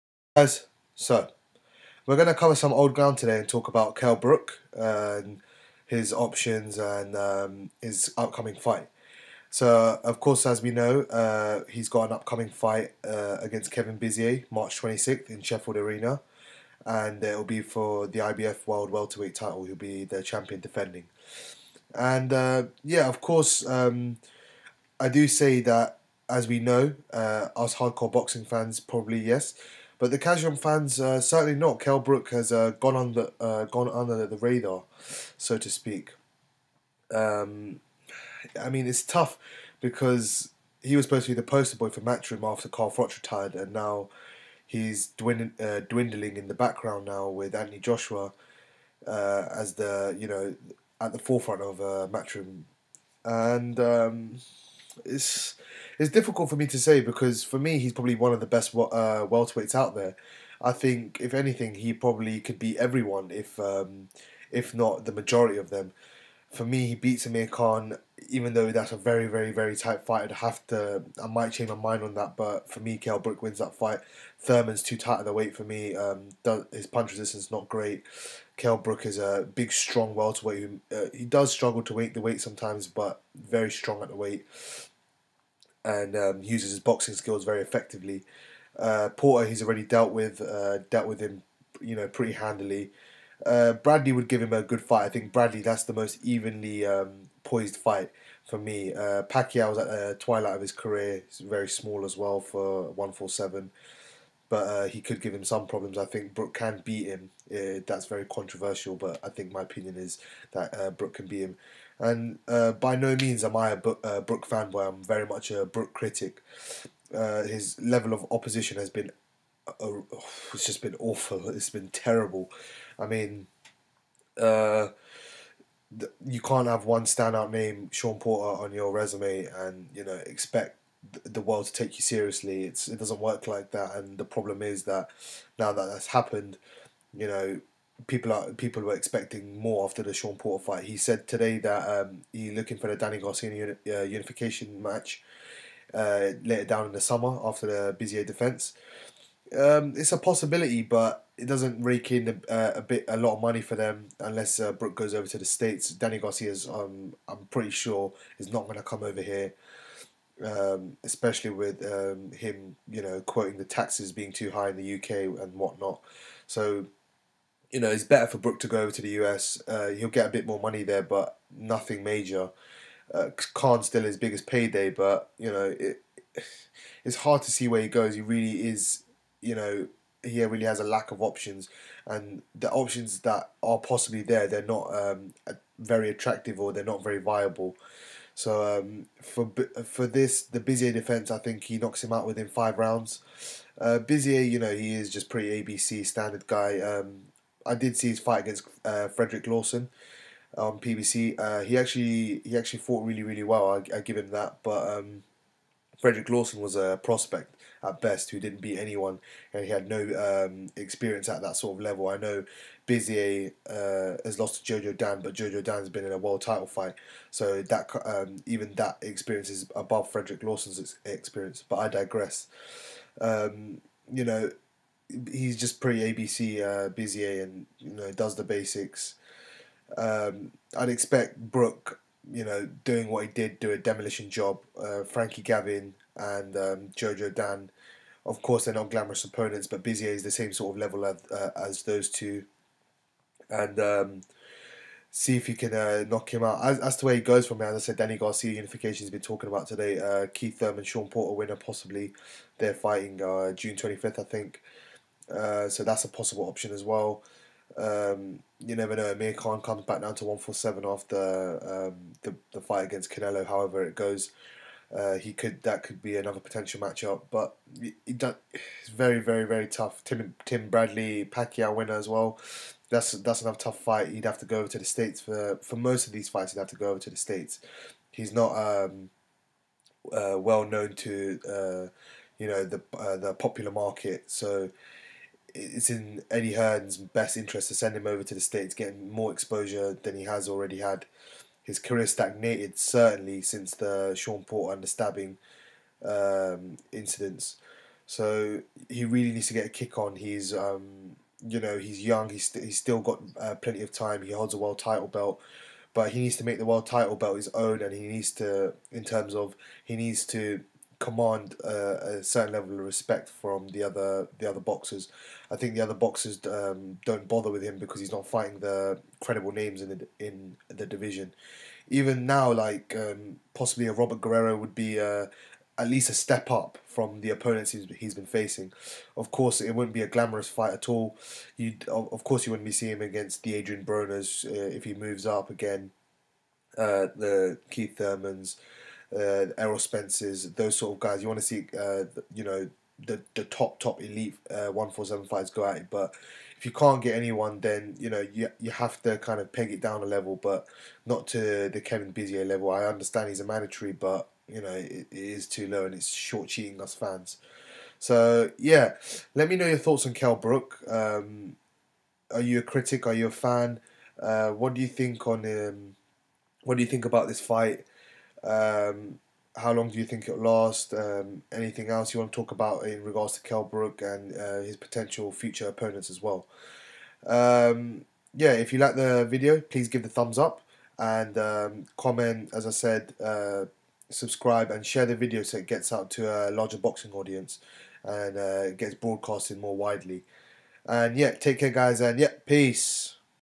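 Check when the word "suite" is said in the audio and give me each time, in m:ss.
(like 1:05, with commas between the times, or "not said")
not said.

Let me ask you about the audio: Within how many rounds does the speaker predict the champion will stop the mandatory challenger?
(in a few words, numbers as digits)
5.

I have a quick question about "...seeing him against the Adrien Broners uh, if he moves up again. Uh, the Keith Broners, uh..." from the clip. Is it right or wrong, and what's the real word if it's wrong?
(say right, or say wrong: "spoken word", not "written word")
wrong: "Thurmans", not "Broners".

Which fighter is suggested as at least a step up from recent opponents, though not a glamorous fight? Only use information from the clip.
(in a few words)
Robert Guerrero.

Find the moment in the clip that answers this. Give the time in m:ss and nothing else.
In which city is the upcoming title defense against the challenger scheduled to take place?
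0:15.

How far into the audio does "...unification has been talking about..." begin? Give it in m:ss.
4:08.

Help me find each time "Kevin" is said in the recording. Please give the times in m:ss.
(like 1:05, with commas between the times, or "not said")
0:13, 5:51.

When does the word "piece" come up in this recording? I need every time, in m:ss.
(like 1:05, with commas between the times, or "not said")
not said.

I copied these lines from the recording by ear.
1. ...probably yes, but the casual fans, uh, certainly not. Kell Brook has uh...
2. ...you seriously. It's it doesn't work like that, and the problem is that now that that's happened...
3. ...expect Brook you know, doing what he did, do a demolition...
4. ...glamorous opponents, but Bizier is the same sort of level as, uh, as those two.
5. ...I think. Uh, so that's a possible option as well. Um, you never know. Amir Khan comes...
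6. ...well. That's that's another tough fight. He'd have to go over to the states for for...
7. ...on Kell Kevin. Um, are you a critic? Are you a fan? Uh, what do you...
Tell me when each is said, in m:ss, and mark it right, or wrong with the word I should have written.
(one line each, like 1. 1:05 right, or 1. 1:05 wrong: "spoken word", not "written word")
1. 0:28 right
2. 2:11 right
3. 3:50 right
4. 3:58 right
5. 4:14 right
6. 4:32 right
7. 6:00 wrong: "Brook", not "Kevin".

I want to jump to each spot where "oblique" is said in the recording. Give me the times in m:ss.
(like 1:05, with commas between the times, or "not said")
not said.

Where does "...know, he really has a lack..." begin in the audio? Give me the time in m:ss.
2:59.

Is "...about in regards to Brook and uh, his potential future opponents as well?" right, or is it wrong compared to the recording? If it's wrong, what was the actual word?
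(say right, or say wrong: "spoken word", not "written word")
right.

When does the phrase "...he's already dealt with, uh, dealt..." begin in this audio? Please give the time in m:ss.
1:29.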